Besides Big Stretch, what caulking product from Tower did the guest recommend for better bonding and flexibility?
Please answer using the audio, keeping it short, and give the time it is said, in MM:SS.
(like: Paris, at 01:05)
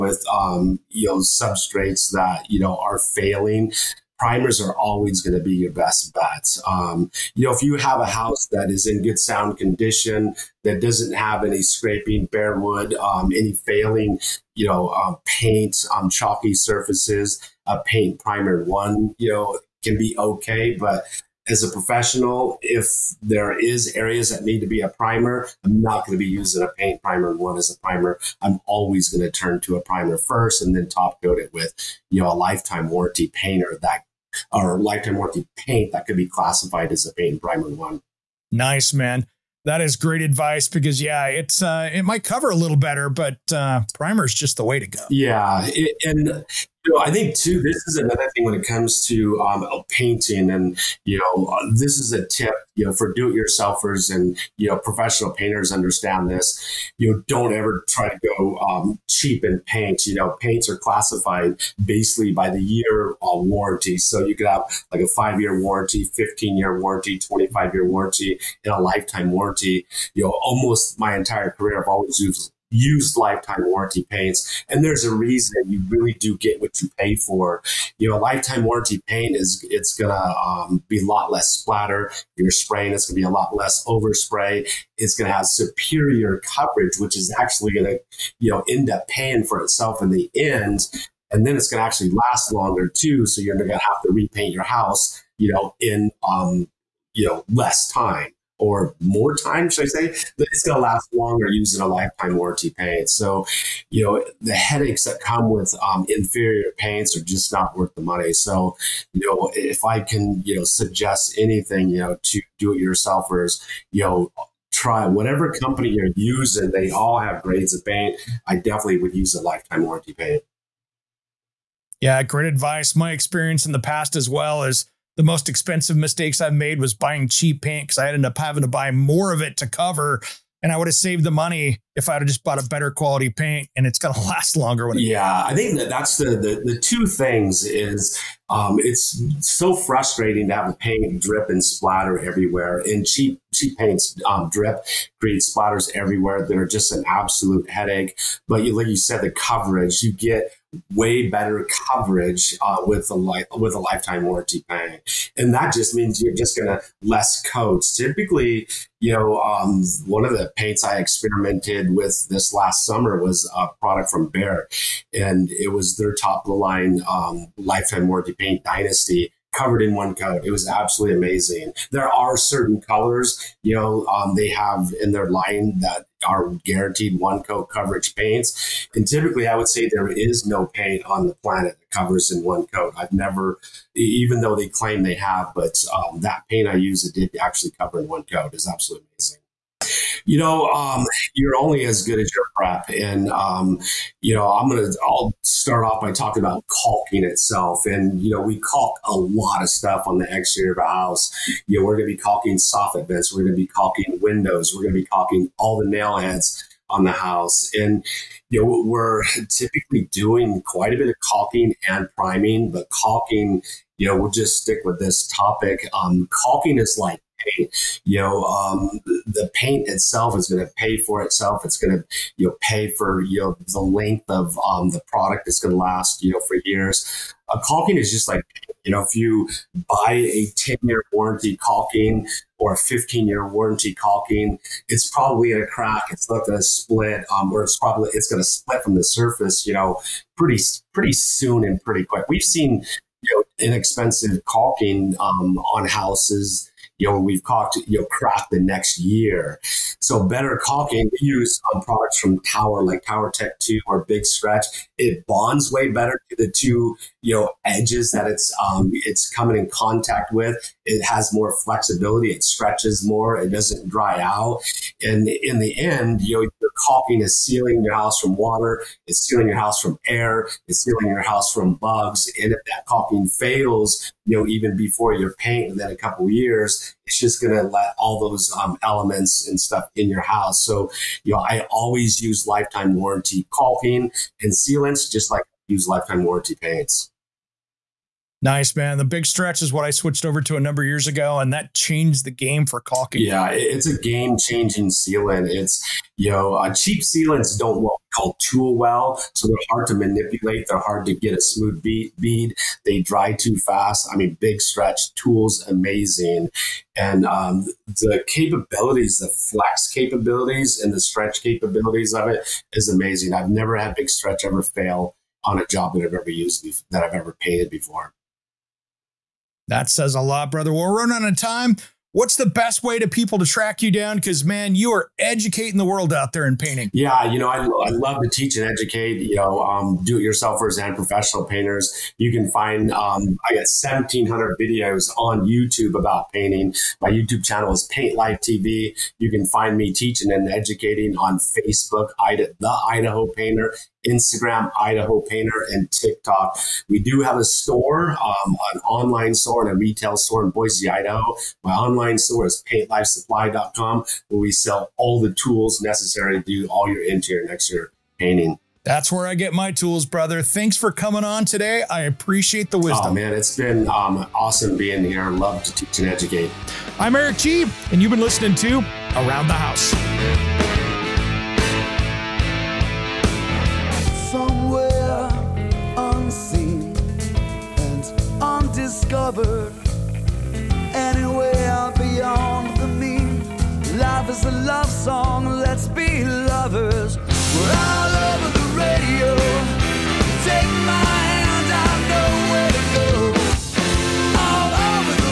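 Tower Tech 2, at 04:13.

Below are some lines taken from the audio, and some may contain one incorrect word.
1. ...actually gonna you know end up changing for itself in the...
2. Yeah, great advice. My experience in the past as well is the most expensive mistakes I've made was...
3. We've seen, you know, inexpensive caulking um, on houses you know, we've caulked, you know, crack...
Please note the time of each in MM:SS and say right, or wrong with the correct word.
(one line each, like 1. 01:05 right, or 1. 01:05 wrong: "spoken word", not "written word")
1. 01:27 wrong: "paying", not "changing"
2. 02:01 right
3. 04:02 right.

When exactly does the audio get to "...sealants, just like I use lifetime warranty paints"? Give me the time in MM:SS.
04:44.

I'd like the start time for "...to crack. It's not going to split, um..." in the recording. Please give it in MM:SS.
03:55.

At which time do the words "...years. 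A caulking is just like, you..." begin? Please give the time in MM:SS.
03:46.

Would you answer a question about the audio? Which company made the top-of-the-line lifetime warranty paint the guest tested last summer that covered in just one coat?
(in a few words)
Behr.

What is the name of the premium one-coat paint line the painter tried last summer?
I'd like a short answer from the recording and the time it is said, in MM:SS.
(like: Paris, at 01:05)
Dynasty, at 02:48.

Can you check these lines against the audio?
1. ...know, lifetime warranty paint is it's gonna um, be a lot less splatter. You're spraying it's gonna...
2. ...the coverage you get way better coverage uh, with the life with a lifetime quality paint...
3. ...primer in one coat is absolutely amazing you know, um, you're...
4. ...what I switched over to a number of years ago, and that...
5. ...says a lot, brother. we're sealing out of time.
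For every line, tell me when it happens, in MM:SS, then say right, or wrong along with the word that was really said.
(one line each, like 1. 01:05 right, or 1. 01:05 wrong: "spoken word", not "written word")
1. 01:18 right
2. 02:29 wrong: "warranty", not "quality"
3. 03:07 wrong: "cover", not "primer"
4. 04:49 right
5. 05:19 wrong: "running", not "sealing".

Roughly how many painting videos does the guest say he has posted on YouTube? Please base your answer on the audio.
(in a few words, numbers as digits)
1,700.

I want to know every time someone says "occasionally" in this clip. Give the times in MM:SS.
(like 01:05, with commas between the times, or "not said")
not said.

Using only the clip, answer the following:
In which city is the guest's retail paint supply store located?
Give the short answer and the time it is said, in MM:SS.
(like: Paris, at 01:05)
Boise, at 05:50.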